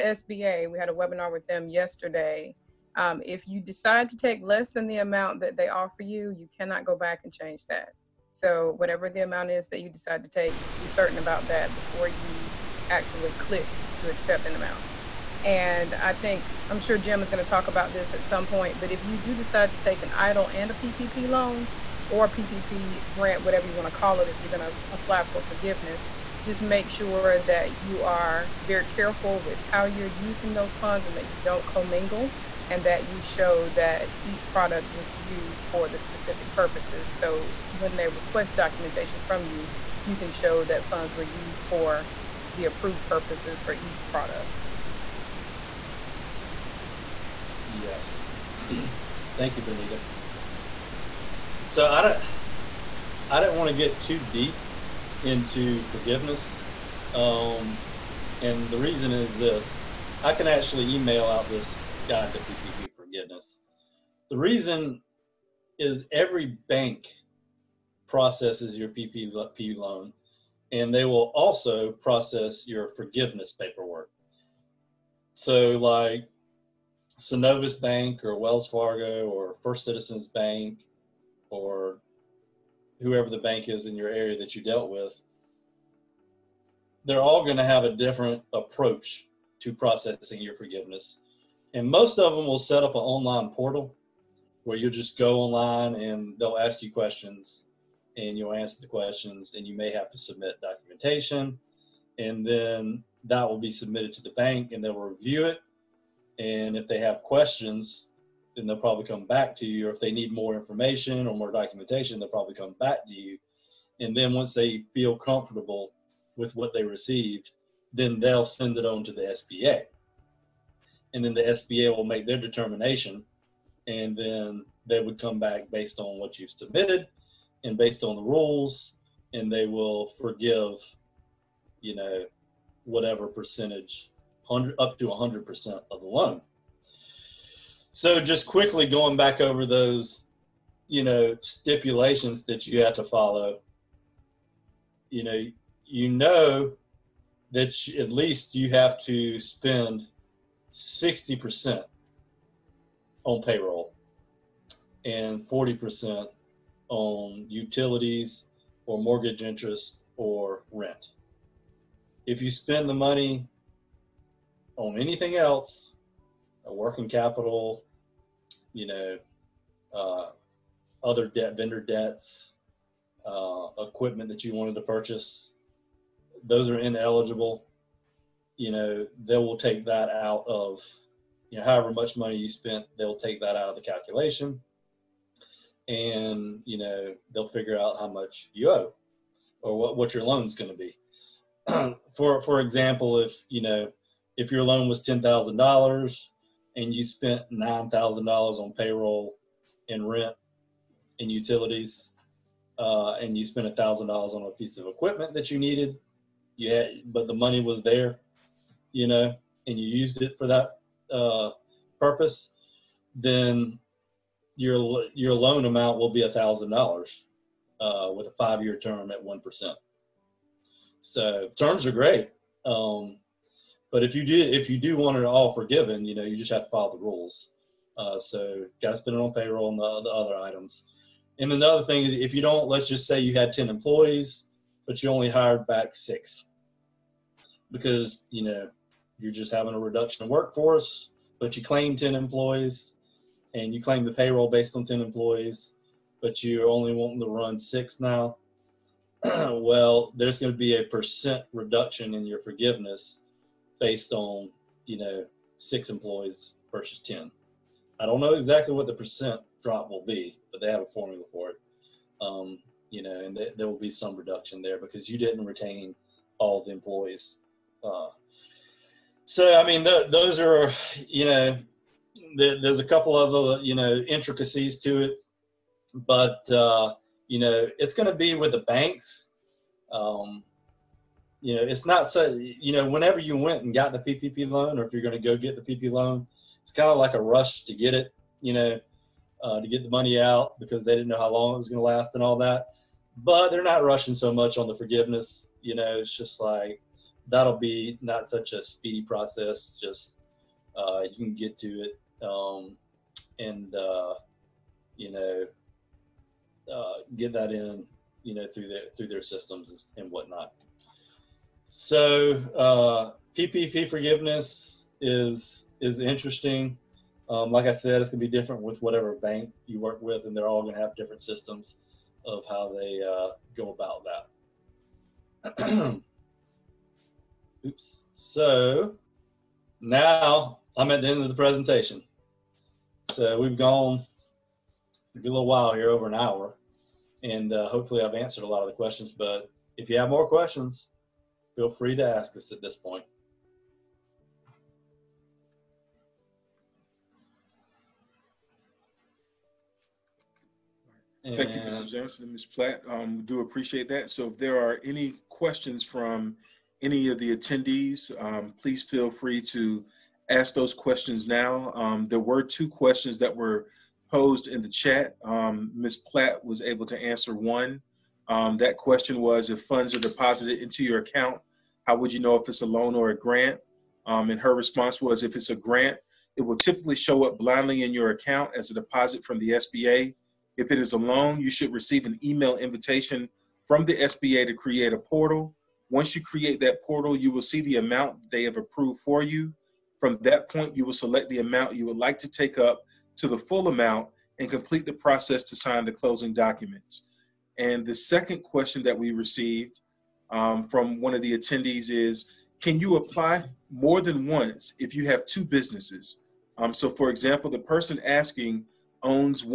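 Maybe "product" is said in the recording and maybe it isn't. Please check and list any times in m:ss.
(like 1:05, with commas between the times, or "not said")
0:34, 0:44.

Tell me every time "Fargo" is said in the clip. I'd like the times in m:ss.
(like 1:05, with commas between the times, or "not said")
1:18.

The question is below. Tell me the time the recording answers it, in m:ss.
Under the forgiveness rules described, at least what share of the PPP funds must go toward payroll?
2:30.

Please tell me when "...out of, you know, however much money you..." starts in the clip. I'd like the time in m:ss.
3:00.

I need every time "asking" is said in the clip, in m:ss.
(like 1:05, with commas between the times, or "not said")
6:48.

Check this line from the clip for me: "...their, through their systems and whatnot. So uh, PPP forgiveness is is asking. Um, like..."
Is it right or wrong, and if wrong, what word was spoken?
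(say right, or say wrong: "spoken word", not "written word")
wrong: "interesting", not "asking".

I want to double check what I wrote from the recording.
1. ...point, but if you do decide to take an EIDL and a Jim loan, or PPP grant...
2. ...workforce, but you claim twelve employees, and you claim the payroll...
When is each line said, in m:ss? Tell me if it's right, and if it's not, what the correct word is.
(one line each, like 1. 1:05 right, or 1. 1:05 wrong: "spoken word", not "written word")
1. 0:18 wrong: "PPP", not "Jim"
2. 4:00 wrong: "ten", not "twelve".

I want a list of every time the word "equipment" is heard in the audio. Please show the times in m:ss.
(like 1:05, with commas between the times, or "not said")
2:53, 3:24.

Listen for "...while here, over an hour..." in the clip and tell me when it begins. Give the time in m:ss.
5:35.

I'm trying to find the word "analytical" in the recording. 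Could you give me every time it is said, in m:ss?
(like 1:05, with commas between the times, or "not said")
not said.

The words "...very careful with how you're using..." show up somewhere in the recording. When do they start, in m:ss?
0:28.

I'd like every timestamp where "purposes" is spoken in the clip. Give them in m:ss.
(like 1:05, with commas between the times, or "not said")
0:36, 0:43, 3:31.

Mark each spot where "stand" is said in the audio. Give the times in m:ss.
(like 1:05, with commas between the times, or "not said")
not said.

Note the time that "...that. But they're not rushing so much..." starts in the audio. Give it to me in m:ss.
4:52.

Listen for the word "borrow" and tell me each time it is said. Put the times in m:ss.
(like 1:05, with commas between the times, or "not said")
not said.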